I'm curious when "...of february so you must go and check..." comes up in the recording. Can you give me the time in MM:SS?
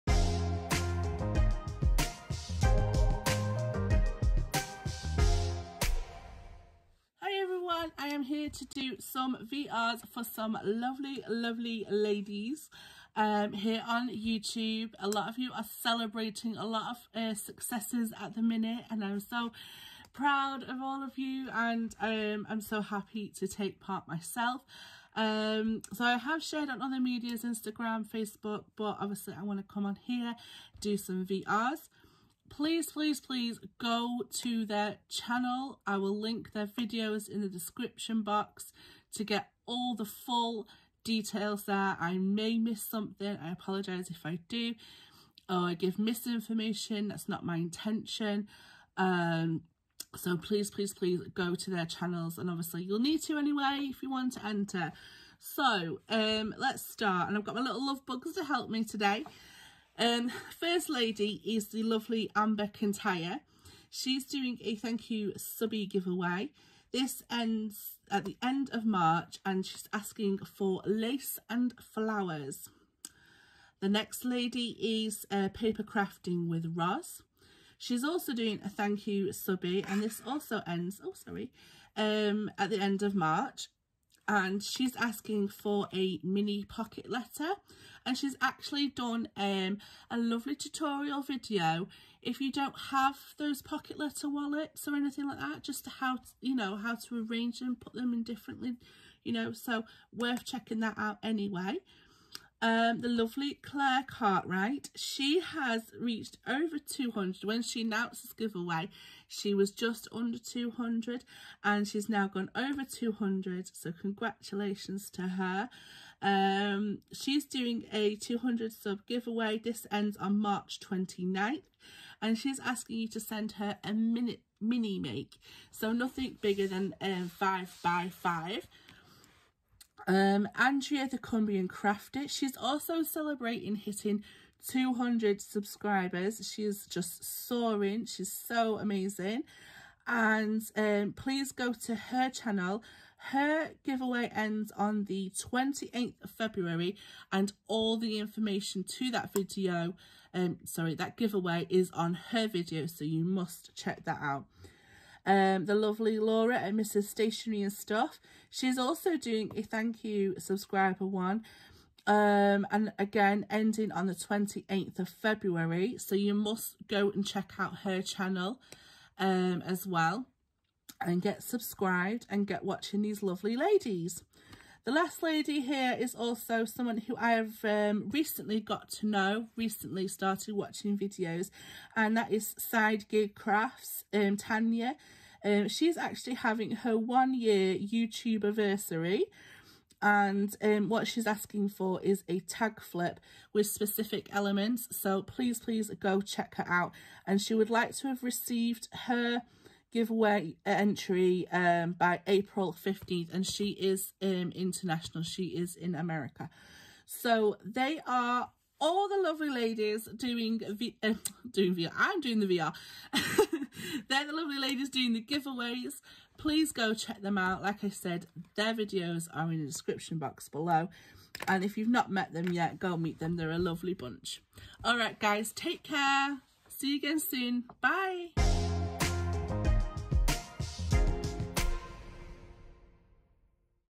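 02:44.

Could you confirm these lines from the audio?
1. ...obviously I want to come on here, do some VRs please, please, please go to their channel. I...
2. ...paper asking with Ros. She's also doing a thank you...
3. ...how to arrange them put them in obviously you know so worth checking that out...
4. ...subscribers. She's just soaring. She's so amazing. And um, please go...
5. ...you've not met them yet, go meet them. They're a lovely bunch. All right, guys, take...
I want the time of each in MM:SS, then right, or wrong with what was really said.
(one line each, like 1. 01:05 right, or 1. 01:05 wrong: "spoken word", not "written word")
1. 00:28 right
2. 01:15 wrong: "crafting", not "asking"
3. 01:36 wrong: "differently", not "obviously"
4. 02:15 right
5. 03:41 right.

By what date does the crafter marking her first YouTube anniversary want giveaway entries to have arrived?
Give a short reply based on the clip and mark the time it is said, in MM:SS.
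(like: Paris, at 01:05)
April 15th, at 03:22.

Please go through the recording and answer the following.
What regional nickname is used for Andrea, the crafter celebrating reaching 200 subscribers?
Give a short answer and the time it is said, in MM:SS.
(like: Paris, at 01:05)
the Cumbrian Crafter, at 02:11.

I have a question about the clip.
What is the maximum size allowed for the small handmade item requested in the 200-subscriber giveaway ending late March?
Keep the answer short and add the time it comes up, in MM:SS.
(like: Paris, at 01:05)
5 by 5, at 02:07.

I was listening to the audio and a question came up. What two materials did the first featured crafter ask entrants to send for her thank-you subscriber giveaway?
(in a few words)
lace and flowers.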